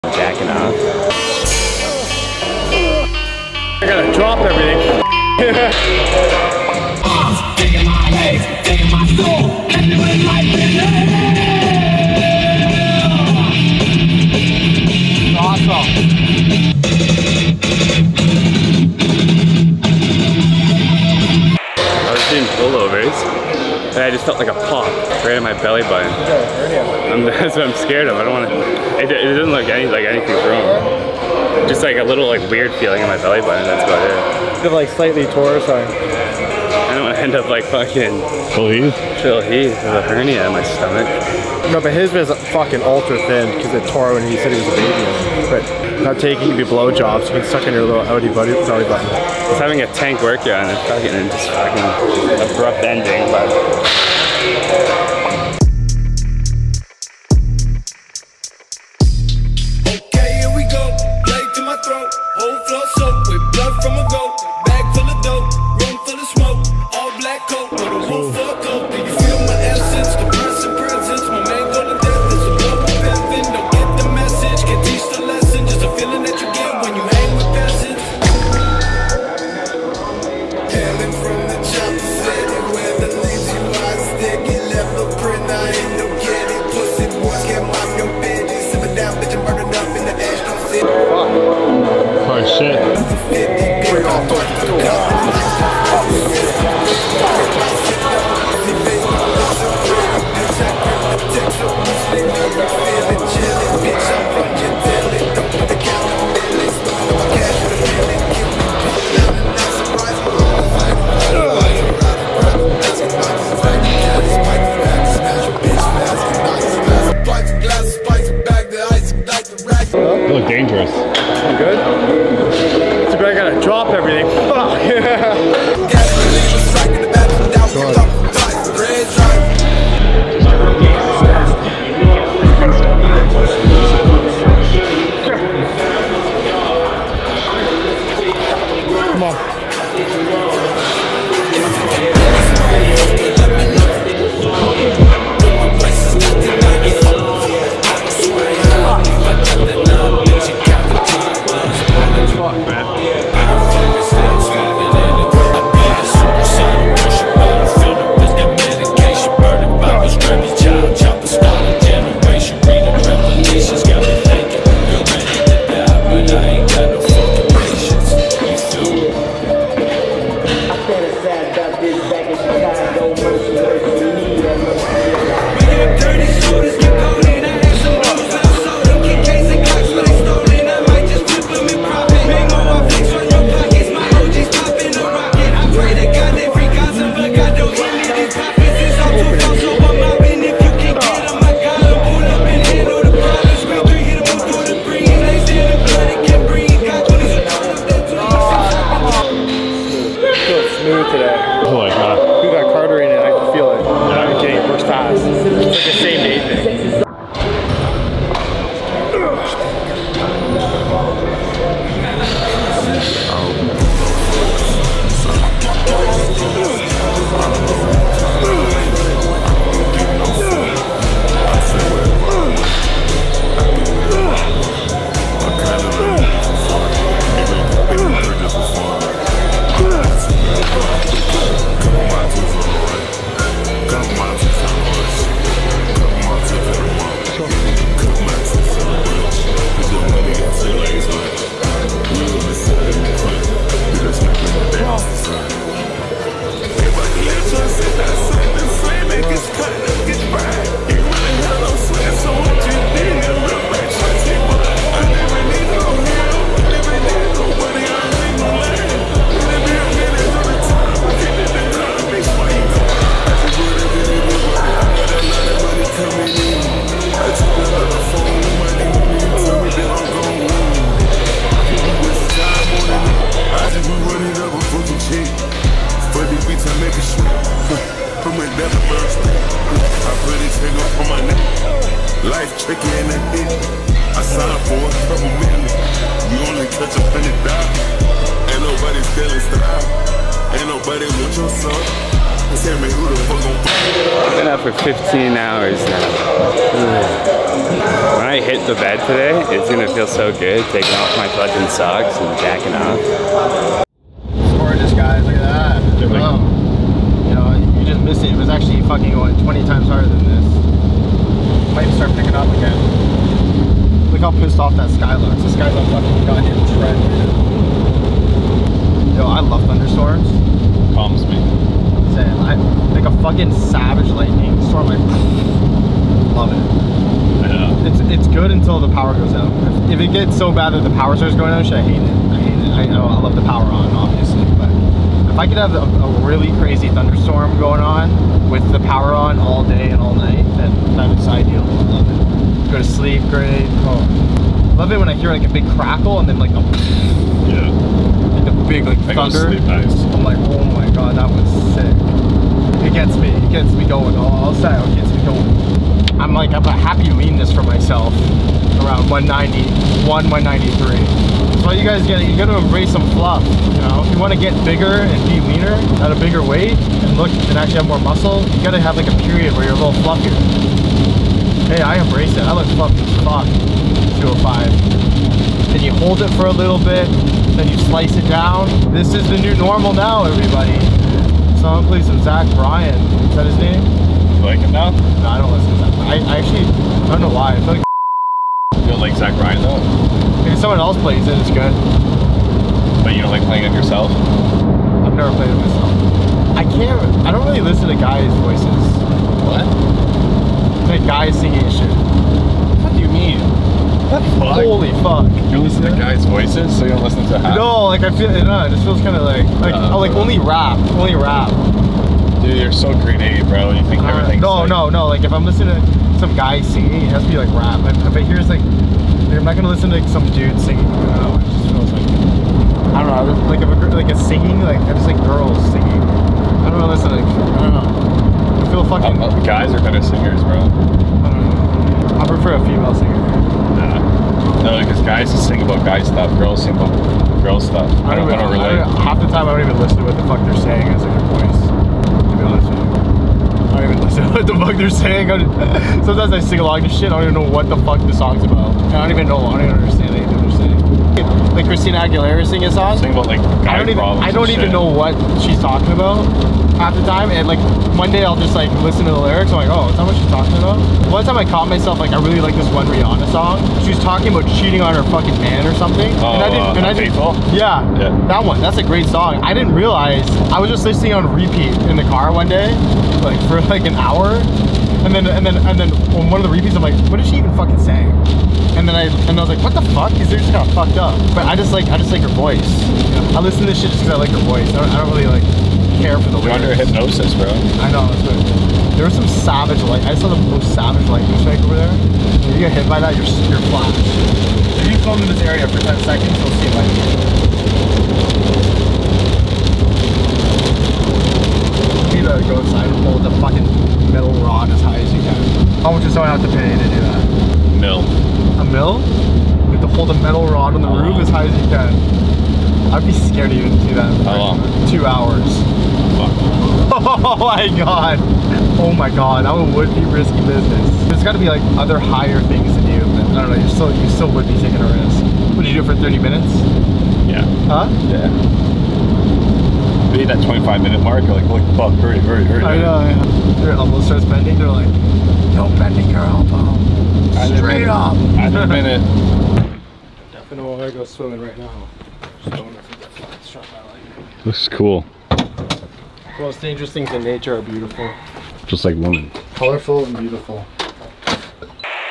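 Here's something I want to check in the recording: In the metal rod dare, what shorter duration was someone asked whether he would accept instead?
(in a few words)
30 minutes.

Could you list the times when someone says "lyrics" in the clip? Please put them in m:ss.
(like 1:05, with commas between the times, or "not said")
7:39, 8:06.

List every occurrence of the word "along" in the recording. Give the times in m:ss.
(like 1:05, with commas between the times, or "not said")
7:26.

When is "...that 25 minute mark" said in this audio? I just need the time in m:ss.
8:50.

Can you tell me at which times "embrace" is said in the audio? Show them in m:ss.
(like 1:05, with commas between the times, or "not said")
6:02, 6:12.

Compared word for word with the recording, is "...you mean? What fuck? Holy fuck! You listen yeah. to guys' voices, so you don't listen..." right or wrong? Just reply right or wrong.
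right.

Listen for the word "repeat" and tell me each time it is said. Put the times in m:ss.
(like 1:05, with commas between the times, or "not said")
7:51, 7:56.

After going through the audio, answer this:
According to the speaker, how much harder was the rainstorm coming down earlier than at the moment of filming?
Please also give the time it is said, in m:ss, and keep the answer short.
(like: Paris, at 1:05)
20 times harder, at 5:09.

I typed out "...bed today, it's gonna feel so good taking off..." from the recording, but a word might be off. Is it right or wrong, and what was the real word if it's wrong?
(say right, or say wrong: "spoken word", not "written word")
right.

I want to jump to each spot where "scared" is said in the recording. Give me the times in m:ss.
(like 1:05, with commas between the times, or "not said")
0:27, 8:33.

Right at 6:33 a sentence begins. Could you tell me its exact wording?
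But you don't like playing it yourself?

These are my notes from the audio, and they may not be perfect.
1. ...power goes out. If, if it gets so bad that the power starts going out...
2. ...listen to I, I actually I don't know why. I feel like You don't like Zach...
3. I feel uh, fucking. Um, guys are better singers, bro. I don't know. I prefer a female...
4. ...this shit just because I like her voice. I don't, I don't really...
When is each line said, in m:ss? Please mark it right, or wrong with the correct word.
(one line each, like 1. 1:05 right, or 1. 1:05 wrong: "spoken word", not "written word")
1. 5:28 right
2. 6:25 right
3. 7:08 right
4. 8:03 right.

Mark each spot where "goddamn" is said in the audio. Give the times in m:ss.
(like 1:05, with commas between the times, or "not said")
5:16.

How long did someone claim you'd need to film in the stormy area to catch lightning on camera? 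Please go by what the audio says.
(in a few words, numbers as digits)
10 seconds.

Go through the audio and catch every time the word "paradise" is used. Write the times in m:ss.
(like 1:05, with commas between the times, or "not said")
not said.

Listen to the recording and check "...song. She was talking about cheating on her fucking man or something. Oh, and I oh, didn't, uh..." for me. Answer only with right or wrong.
right.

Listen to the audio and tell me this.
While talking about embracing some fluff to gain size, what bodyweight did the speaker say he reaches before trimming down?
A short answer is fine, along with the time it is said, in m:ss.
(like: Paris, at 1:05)
205, at 6:14.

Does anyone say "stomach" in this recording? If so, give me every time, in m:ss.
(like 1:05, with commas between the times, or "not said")
0:40.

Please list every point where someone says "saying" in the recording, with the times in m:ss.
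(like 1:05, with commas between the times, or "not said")
7:20, 7:24, 7:30, 7:57.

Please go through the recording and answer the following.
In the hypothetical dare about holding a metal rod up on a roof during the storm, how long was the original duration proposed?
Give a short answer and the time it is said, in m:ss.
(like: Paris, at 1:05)
2 hours, at 8:34.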